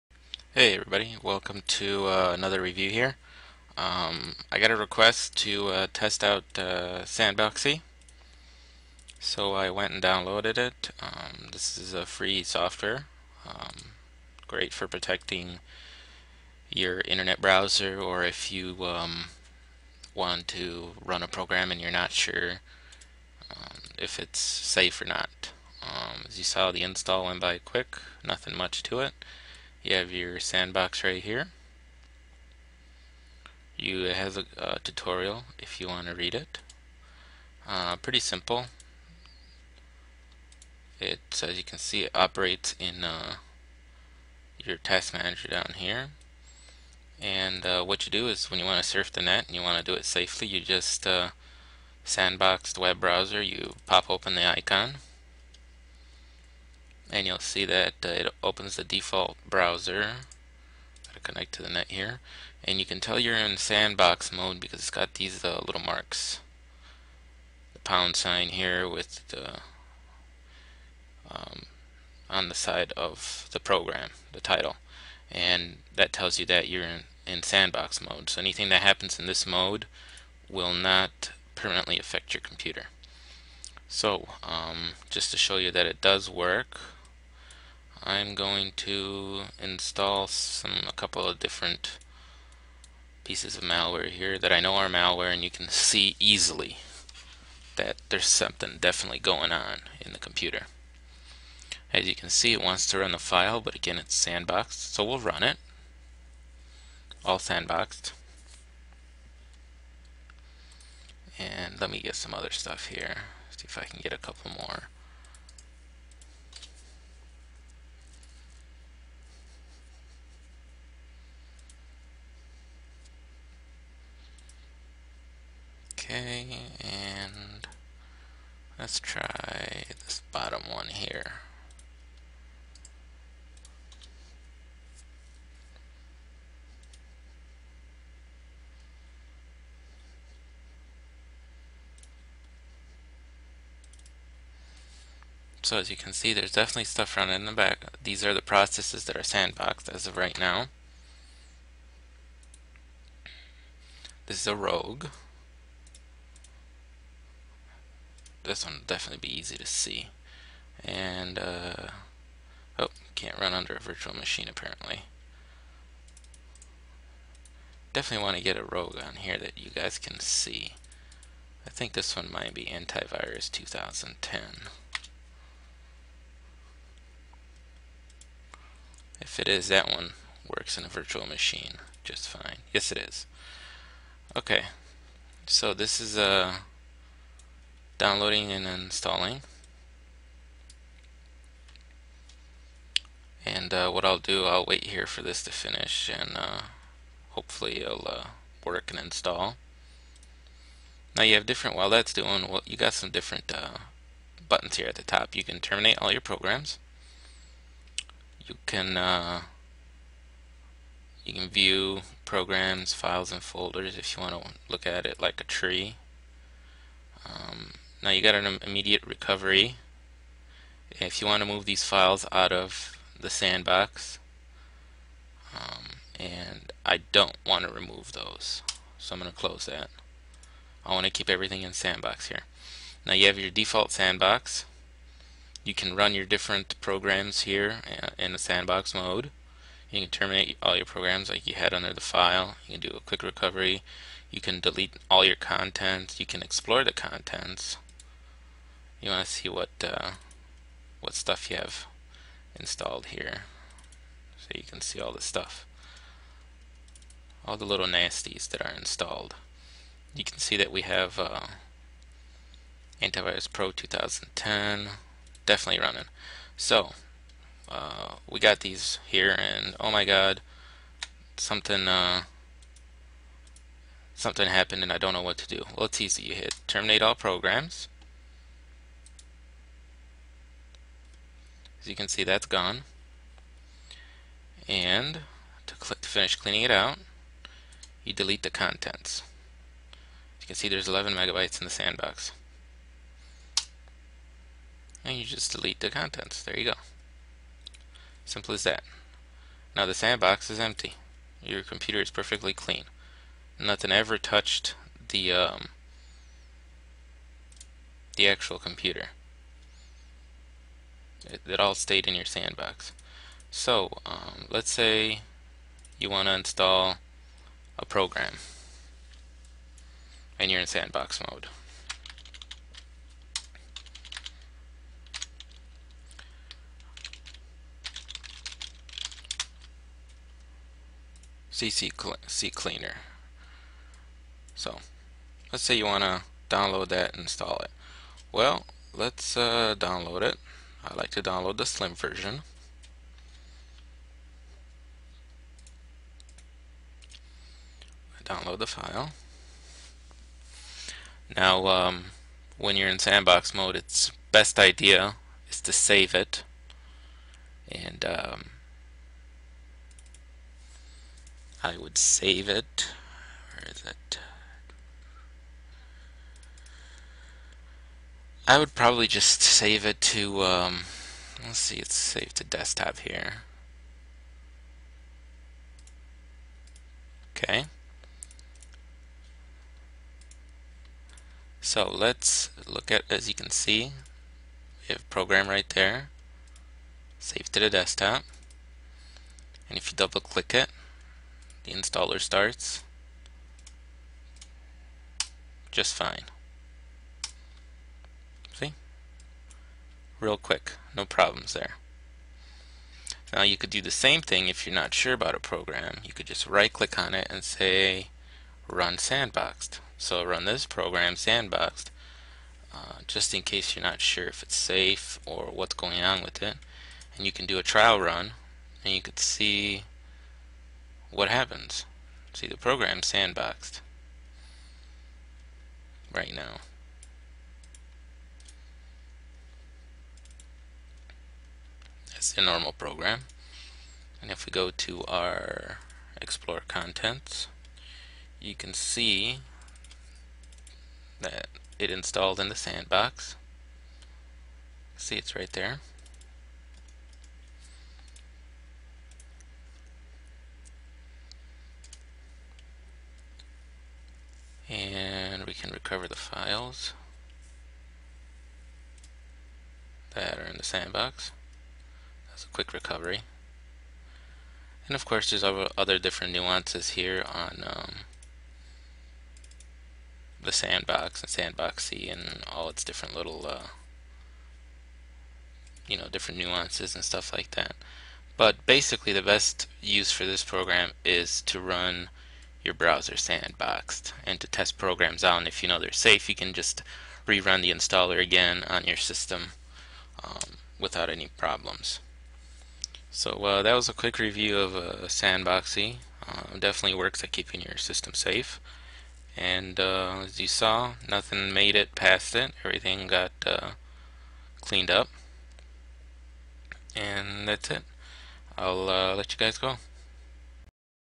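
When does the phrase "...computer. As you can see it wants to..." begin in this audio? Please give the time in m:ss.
1:40.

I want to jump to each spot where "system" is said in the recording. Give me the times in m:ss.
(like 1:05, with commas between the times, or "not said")
8:08, 8:17.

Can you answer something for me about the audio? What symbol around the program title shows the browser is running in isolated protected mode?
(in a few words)
pound sign.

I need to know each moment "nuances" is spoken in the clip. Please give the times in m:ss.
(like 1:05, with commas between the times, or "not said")
7:46, 7:56.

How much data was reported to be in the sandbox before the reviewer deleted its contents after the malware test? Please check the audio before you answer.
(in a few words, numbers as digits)
11 megabytes.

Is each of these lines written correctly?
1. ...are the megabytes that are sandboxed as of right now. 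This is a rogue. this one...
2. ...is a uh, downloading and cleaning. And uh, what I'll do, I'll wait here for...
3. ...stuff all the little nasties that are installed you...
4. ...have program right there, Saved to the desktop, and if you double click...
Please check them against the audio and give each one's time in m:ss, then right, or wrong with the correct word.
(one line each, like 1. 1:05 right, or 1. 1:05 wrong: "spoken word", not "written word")
1. 2:28 wrong: "processes", not "megabytes"
2. 3:06 wrong: "installing", not "cleaning"
3. 4:15 right
4. 6:24 right.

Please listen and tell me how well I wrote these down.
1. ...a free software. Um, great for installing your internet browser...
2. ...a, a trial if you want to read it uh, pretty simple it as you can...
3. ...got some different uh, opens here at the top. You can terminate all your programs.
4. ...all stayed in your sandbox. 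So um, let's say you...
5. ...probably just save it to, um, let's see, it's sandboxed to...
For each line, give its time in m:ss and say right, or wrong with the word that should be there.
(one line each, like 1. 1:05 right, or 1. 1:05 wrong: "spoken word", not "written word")
1. 0:11 wrong: "protecting", not "installing"
2. 0:34 wrong: "tutorial", not "trial"
3. 3:22 wrong: "buttons", not "opens"
4. 5:11 right
5. 6:08 wrong: "saved", not "sandboxed".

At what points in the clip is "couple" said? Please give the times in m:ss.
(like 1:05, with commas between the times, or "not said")
1:30, 1:54.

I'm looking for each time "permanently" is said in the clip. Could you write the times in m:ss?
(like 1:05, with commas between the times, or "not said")
1:21.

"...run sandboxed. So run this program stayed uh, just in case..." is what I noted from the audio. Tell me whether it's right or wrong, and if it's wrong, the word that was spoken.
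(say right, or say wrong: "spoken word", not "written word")
wrong: "sandboxed", not "stayed".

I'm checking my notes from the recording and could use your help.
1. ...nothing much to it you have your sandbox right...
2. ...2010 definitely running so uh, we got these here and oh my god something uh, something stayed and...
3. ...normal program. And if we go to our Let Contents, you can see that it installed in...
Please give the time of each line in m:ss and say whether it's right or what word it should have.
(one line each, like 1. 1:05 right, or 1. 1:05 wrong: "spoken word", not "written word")
1. 0:28 right
2. 4:23 wrong: "happened", not "stayed"
3. 7:12 wrong: "Explore", not "Let".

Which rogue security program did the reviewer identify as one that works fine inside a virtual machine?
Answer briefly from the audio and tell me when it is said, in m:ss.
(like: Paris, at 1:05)
Antivirus 2010, at 2:52.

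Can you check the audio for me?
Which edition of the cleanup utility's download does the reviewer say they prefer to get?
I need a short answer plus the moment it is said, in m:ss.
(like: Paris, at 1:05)
slim version, at 5:41.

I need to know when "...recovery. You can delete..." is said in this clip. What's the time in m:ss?
4:03.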